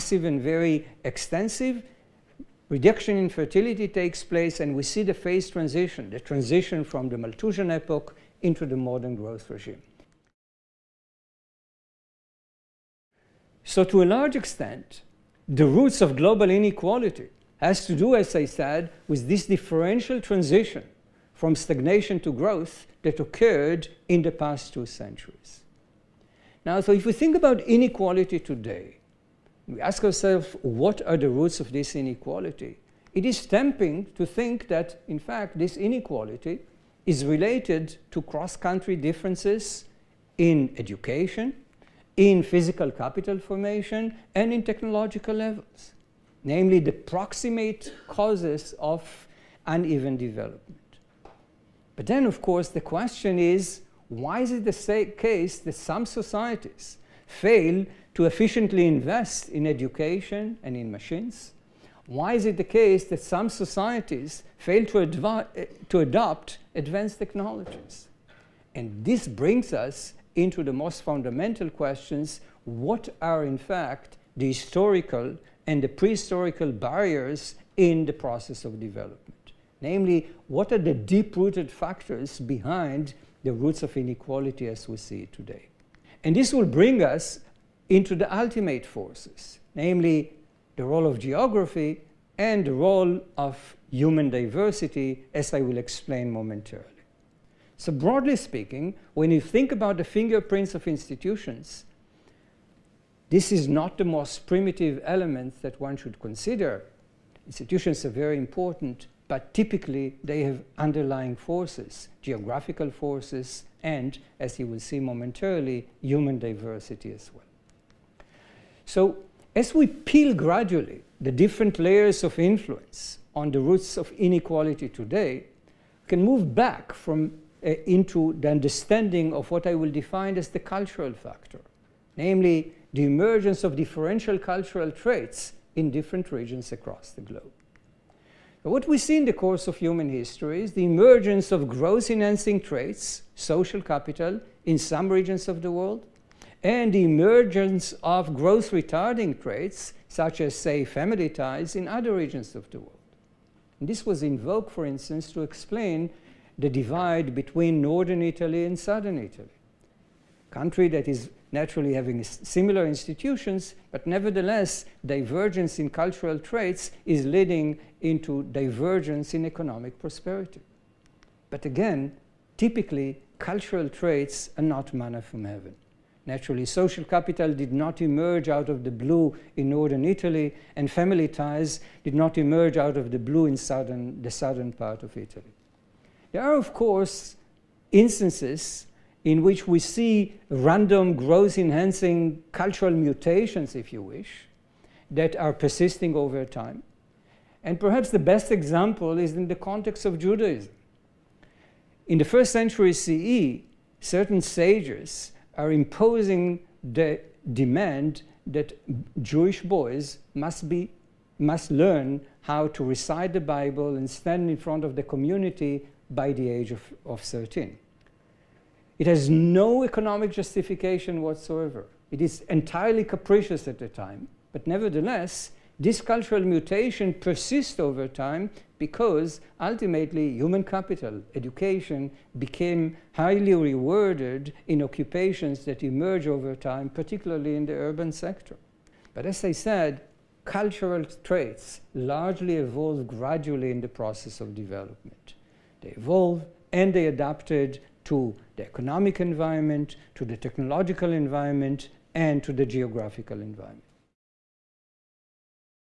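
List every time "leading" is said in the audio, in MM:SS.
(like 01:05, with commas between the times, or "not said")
02:47.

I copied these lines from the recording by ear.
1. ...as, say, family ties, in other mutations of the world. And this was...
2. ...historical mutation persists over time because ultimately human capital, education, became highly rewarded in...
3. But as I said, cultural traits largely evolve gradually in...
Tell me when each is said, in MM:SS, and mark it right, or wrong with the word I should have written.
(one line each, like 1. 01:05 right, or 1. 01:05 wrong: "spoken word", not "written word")
1. 02:30 wrong: "regions", not "mutations"
2. 03:46 wrong: "cultural", not "historical"
3. 03:59 right.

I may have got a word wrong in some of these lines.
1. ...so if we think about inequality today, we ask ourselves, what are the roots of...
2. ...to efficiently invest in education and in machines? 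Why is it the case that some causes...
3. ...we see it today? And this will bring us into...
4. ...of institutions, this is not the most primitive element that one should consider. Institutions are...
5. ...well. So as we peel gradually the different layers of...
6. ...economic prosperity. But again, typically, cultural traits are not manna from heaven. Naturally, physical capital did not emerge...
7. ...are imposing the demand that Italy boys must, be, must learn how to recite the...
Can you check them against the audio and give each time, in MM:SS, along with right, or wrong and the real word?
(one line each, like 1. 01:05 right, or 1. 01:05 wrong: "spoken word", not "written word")
1. 00:26 right
2. 00:58 wrong: "societies", not "causes"
3. 01:24 right
4. 01:40 right
5. 01:57 right
6. 02:49 wrong: "social", not "physical"
7. 03:25 wrong: "Jewish", not "Italy".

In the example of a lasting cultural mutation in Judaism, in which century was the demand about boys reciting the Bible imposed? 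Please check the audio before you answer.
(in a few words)
First century CE.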